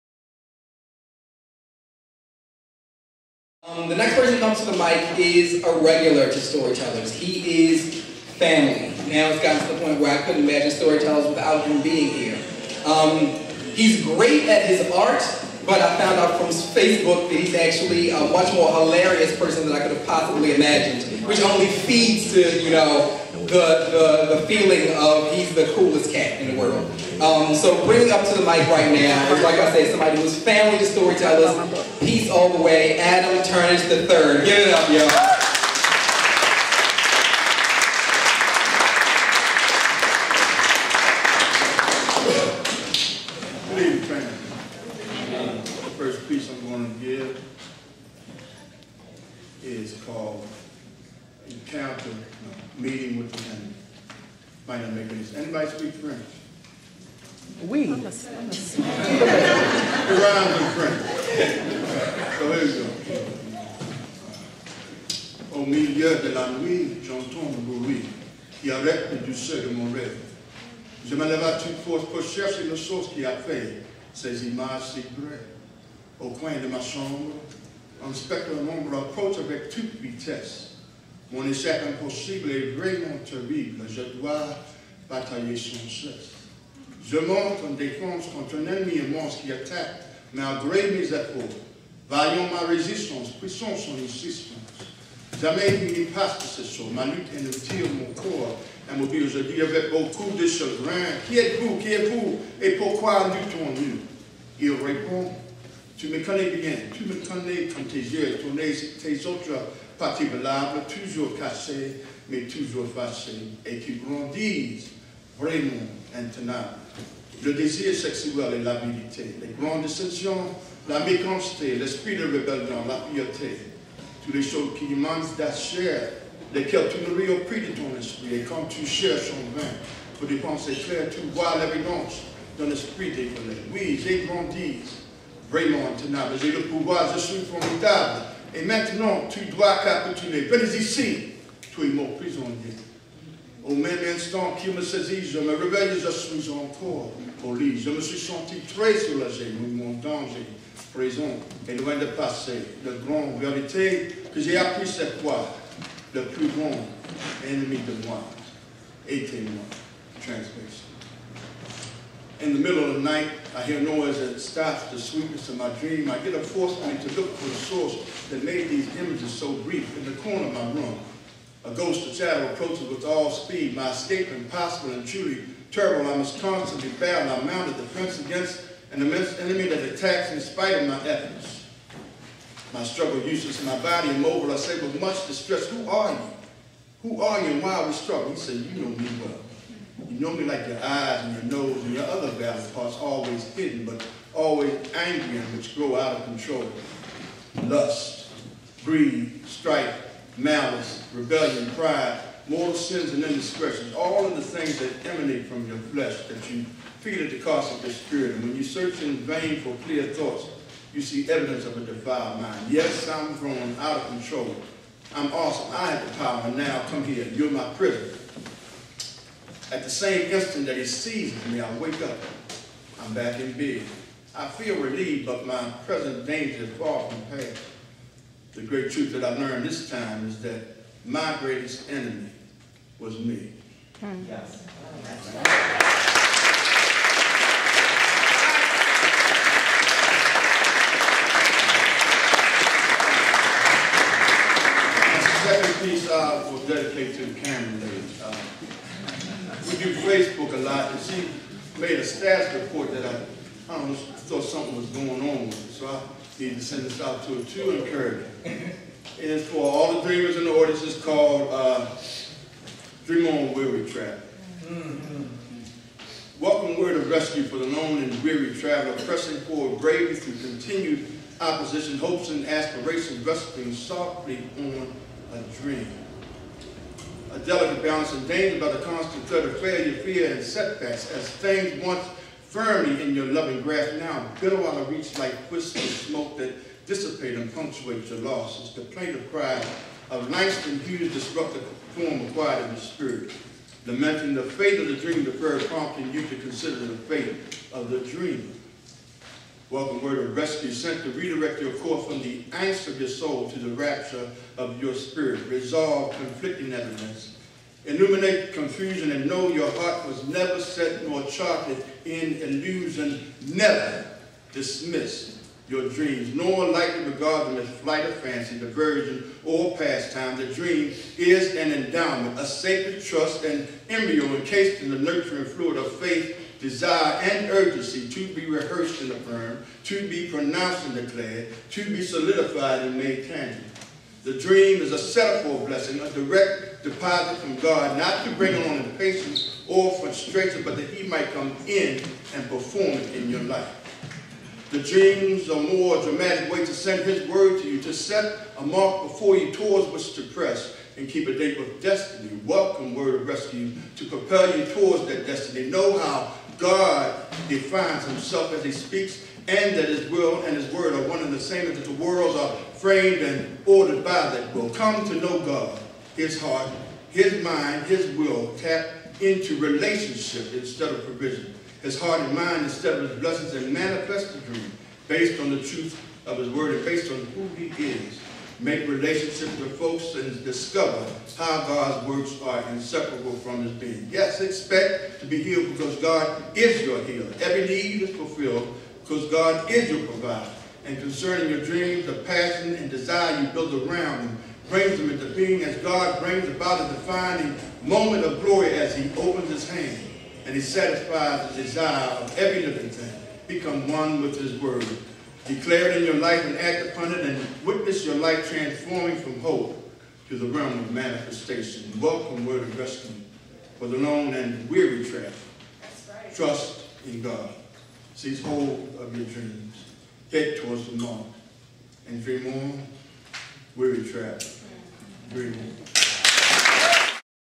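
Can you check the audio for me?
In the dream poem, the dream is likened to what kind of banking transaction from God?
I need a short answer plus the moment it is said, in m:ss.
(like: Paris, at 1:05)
Direct deposit, at 5:36.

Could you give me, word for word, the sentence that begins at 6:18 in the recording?
Make relationships with folks and discover how God's works are inseparable from his being.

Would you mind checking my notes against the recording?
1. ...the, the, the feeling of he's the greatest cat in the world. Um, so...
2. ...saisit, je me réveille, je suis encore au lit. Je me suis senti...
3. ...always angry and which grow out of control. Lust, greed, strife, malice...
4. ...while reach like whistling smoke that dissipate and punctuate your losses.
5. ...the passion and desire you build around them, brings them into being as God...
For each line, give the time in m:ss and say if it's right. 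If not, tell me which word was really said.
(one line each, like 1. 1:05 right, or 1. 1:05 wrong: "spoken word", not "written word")
1. 0:23 wrong: "coolest", not "greatest"
2. 2:24 right
3. 3:14 right
4. 4:44 right
5. 6:32 right.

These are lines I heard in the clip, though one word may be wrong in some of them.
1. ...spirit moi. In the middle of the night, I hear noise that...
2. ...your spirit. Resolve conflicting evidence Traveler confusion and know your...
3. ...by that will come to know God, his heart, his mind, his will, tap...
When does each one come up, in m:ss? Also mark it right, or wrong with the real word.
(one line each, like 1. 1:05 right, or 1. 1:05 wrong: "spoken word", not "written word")
1. 2:39 wrong: "était", not "spirit"
2. 5:04 wrong: "Illuminate", not "Traveler"
3. 6:04 right.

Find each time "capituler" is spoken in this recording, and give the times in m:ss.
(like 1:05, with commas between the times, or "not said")
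2:19.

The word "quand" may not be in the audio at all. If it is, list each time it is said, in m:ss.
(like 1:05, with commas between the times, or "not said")
1:47, 2:08.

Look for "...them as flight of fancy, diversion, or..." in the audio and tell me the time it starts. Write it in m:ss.
5:17.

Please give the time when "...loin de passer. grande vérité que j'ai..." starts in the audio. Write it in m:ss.
2:31.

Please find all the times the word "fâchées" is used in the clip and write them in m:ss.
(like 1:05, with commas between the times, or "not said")
1:52.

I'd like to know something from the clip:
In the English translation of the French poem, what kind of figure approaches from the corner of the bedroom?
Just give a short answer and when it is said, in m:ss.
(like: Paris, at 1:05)
A ghost of shadow, at 2:51.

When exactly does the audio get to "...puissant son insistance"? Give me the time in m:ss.
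1:33.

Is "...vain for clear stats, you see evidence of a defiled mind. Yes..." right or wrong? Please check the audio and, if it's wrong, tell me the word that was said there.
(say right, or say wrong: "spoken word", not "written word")
wrong: "thoughts", not "stats".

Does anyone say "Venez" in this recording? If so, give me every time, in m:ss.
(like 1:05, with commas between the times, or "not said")
2:20.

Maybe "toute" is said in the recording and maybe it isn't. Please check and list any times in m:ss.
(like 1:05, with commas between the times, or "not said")
1:11, 1:19, 2:04.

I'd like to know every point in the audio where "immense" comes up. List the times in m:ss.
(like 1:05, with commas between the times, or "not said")
1:29, 2:59.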